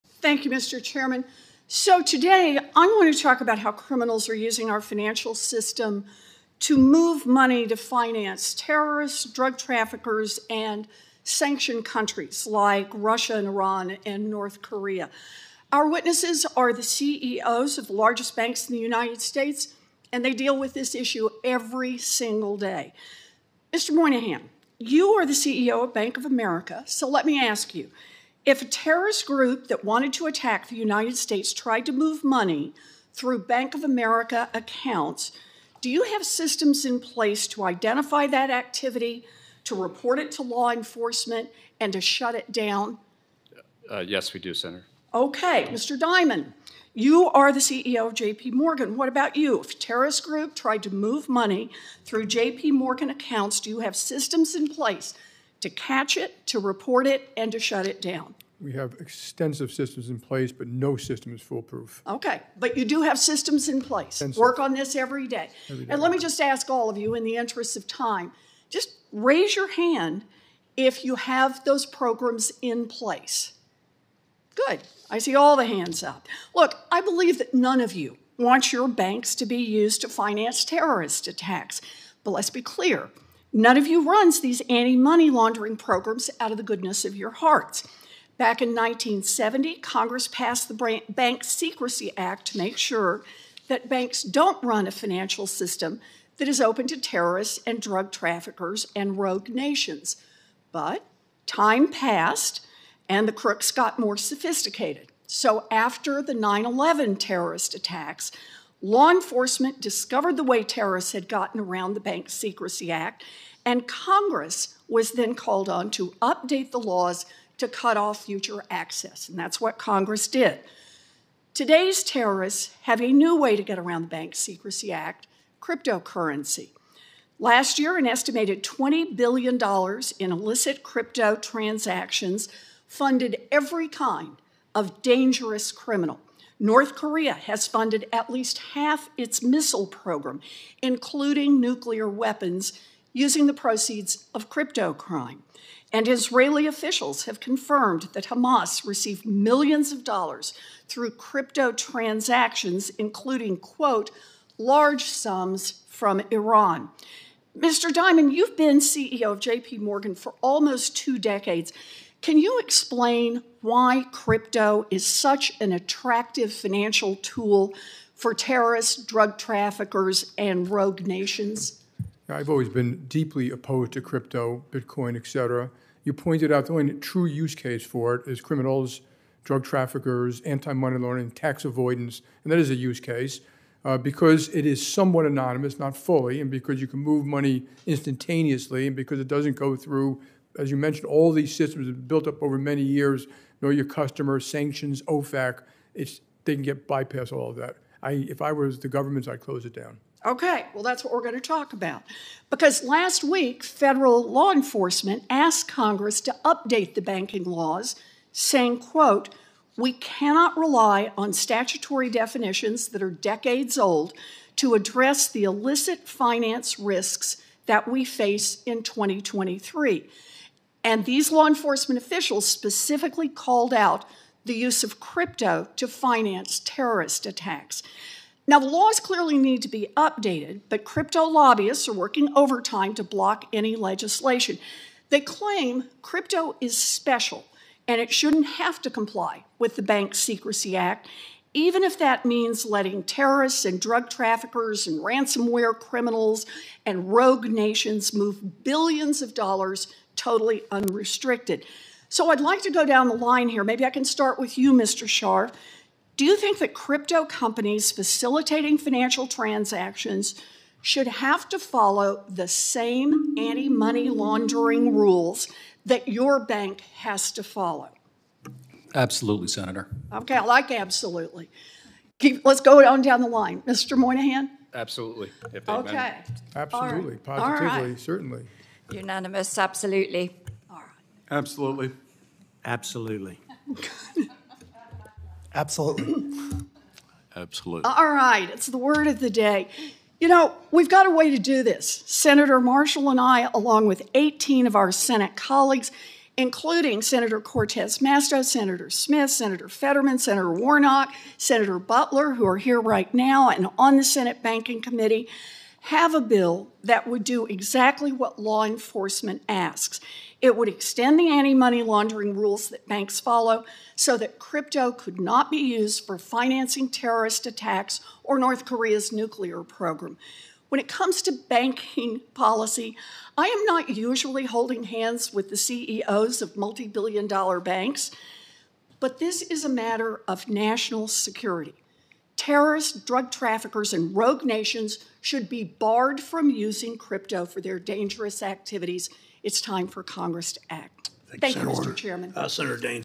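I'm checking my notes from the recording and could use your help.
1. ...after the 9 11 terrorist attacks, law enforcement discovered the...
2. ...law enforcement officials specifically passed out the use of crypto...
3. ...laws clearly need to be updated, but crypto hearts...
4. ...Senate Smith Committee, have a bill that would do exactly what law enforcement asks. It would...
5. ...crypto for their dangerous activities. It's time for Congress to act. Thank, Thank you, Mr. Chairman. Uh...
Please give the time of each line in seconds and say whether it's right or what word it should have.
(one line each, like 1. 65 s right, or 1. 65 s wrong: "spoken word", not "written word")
1. 105 s right
2. 221 s wrong: "called", not "passed"
3. 228 s wrong: "lobbyists", not "hearts"
4. 304 s wrong: "Banking", not "Smith"
5. 336 s right.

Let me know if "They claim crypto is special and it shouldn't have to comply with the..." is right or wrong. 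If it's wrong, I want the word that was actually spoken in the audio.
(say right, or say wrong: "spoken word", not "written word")
right.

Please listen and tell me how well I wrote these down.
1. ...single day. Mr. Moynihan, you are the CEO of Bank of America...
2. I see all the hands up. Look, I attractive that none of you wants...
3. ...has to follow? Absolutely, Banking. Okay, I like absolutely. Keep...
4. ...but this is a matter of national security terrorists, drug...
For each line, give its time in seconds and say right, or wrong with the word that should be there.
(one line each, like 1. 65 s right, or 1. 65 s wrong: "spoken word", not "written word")
1. 21 s right
2. 75 s wrong: "believe", not "attractive"
3. 266 s wrong: "Senator", not "Banking"
4. 328 s right.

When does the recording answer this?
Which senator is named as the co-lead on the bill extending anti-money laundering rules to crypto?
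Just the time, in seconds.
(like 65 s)
292 s.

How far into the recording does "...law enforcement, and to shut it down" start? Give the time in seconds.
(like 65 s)
40 s.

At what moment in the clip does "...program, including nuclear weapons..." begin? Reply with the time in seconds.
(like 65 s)
139 s.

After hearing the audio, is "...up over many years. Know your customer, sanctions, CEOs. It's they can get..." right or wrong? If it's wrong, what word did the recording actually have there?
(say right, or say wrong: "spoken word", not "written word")
wrong: "OFAC", not "CEOs".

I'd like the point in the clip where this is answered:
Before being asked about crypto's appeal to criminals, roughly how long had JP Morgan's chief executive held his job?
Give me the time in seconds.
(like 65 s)
160 s.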